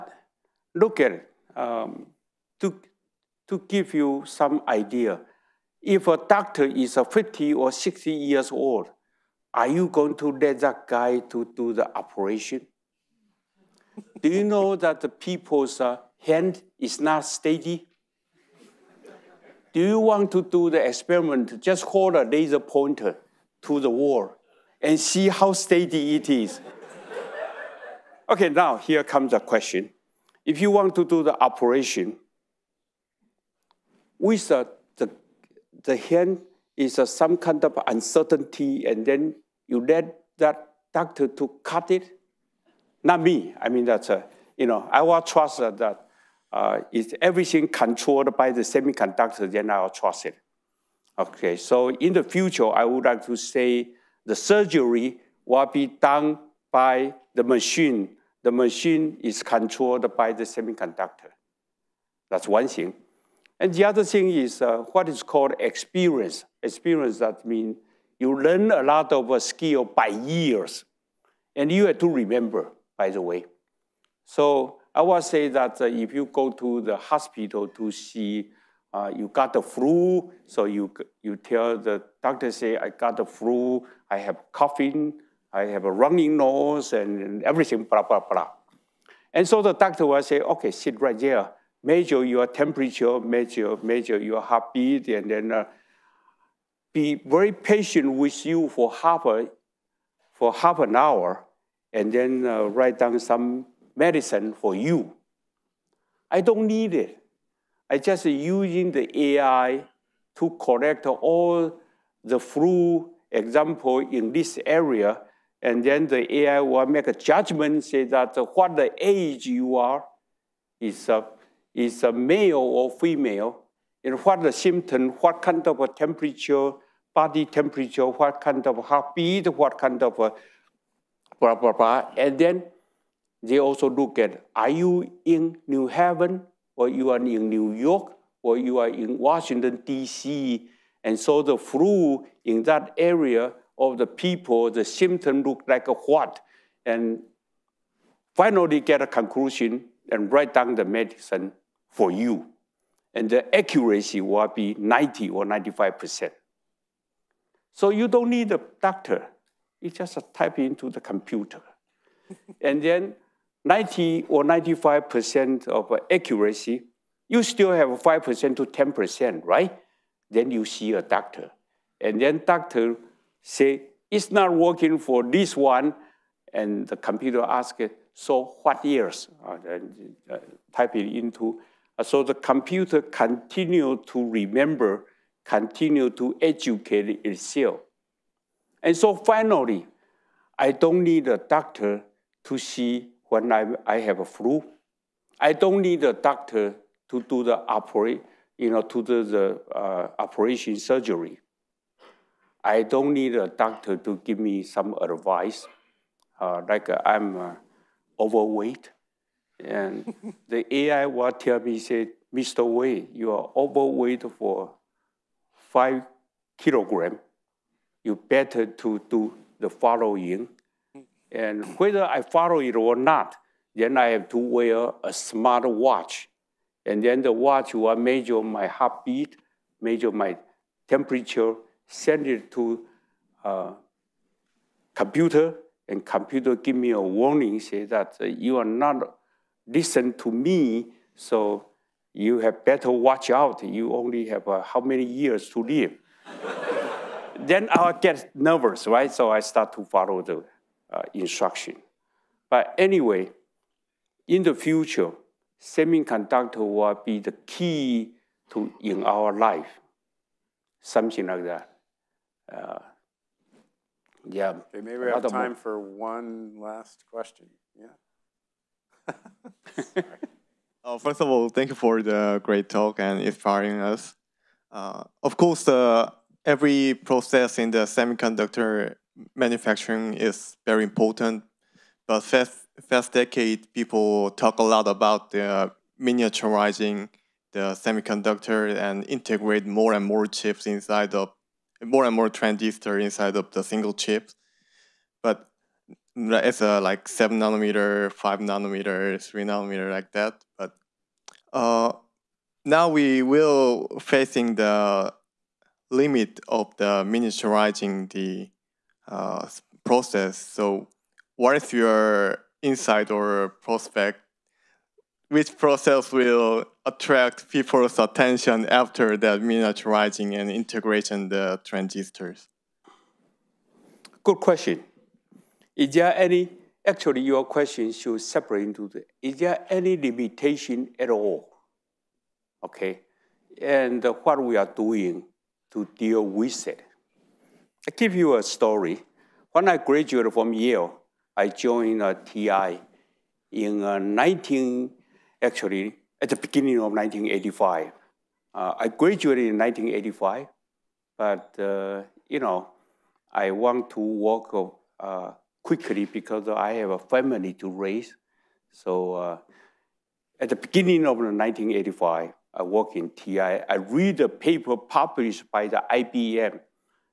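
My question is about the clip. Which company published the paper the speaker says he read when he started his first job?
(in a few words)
IBM.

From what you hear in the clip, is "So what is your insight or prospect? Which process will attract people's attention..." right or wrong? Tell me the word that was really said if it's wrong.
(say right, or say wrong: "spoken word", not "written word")
right.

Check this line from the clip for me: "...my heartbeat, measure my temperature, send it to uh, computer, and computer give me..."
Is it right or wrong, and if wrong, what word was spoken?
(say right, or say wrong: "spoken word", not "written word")
right.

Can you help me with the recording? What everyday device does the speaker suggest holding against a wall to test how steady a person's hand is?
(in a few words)
laser pointer.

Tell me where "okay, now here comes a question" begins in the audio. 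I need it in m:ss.
0:28.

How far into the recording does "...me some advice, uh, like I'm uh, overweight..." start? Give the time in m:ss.
3:24.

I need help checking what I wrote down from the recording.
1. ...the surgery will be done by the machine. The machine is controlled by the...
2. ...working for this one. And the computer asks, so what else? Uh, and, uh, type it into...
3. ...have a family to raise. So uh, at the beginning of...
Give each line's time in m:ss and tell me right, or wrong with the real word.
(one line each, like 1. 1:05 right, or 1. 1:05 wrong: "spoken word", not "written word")
1. 0:54 right
2. 2:54 right
3. 5:56 right.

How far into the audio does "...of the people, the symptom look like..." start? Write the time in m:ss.
2:23.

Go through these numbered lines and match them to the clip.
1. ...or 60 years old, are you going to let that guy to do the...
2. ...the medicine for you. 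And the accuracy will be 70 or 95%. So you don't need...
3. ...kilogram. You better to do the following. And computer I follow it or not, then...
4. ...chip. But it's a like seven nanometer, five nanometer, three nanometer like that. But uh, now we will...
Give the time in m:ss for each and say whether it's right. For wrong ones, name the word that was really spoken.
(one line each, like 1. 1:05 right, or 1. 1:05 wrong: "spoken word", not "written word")
1. 0:07 right
2. 2:30 wrong: "90", not "70"
3. 3:36 wrong: "whether", not "computer"
4. 4:53 right.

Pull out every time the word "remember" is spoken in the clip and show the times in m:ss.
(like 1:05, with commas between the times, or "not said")
1:12, 3:04.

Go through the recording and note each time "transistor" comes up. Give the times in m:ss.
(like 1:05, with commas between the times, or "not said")
4:52, 5:21.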